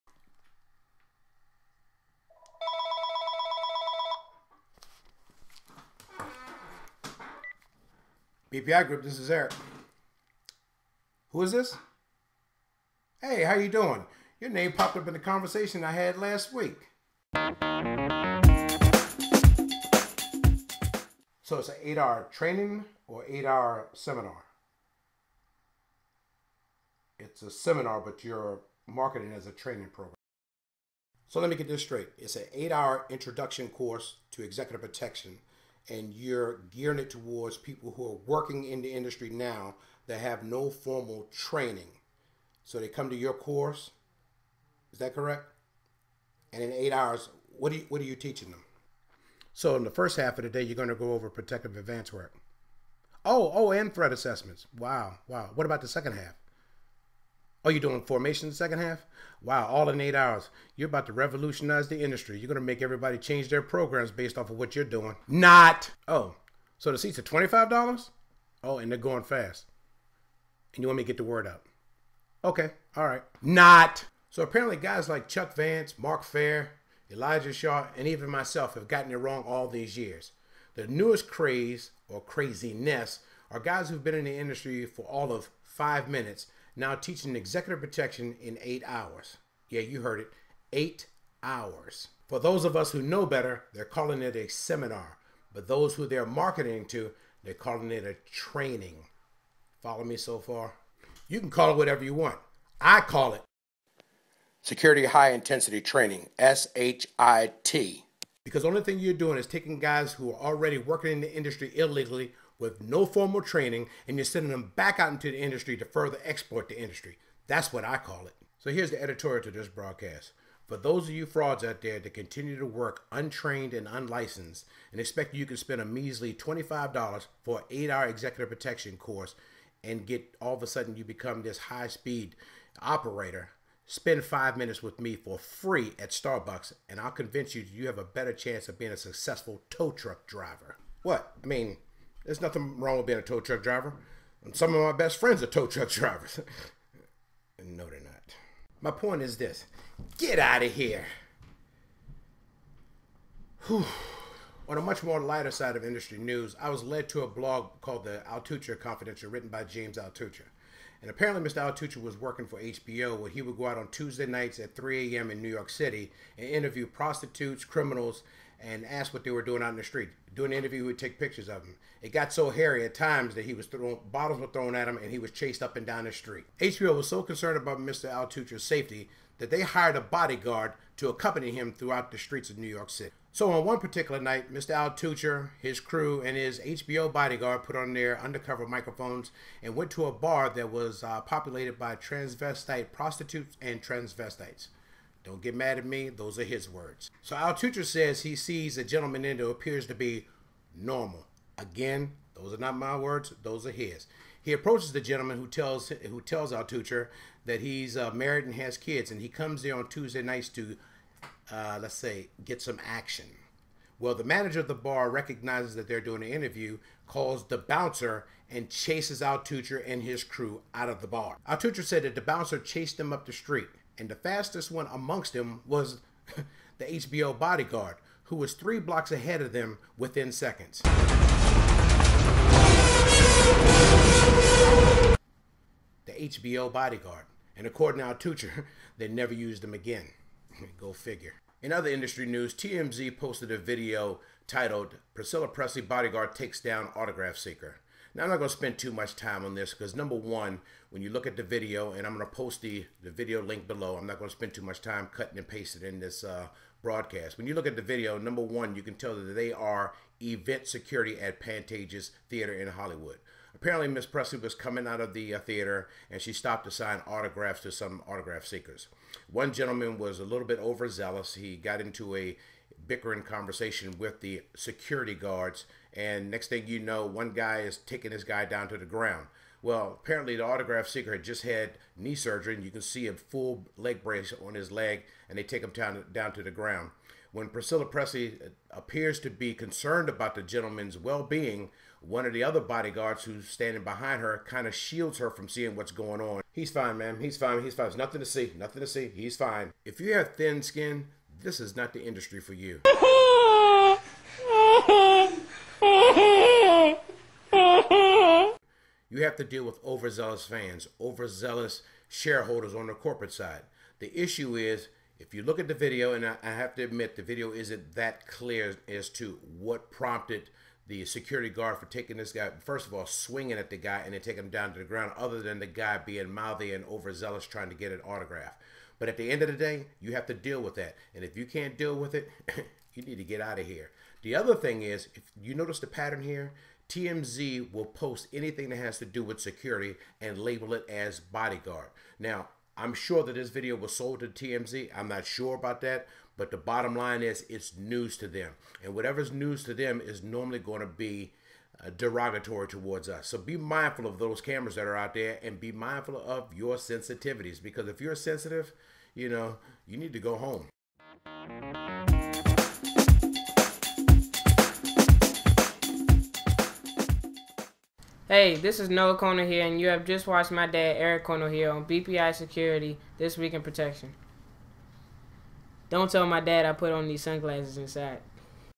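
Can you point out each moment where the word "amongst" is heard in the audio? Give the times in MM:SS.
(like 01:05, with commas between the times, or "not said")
03:44.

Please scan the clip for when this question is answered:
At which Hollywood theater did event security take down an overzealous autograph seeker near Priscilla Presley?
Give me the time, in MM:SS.
04:21.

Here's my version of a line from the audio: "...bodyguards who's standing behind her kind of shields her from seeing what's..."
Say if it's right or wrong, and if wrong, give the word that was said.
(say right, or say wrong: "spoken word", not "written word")
right.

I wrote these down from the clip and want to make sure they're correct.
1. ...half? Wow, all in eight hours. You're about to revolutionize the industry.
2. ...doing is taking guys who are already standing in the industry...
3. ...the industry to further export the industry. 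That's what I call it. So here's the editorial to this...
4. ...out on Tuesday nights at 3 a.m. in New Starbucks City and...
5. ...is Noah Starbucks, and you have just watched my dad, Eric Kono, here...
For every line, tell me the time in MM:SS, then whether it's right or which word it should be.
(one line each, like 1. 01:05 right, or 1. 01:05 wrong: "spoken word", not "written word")
1. 00:58 right
2. 01:49 wrong: "working", not "standing"
3. 01:55 right
4. 02:43 wrong: "York", not "Starbucks"
5. 06:08 wrong: "Konohia", not "Starbucks".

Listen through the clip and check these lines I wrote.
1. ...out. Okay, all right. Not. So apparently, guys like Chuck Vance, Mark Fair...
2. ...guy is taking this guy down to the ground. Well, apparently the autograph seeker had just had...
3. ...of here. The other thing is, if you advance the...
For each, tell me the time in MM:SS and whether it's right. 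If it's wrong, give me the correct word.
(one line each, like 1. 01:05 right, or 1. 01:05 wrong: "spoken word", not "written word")
1. 01:11 right
2. 04:37 right
3. 05:33 wrong: "notice", not "advance".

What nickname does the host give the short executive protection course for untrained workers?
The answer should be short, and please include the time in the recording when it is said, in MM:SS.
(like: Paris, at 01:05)
Security High Intensity Training, at 01:44.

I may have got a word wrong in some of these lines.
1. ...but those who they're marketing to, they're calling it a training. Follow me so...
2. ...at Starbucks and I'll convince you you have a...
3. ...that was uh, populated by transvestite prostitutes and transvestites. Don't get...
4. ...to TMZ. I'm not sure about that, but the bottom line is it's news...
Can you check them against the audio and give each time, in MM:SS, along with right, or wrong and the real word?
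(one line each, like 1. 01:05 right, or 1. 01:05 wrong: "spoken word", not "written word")
1. 01:35 right
2. 02:15 right
3. 03:10 right
4. 05:44 right.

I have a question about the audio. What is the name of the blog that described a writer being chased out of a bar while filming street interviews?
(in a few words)
Altucher Confidential.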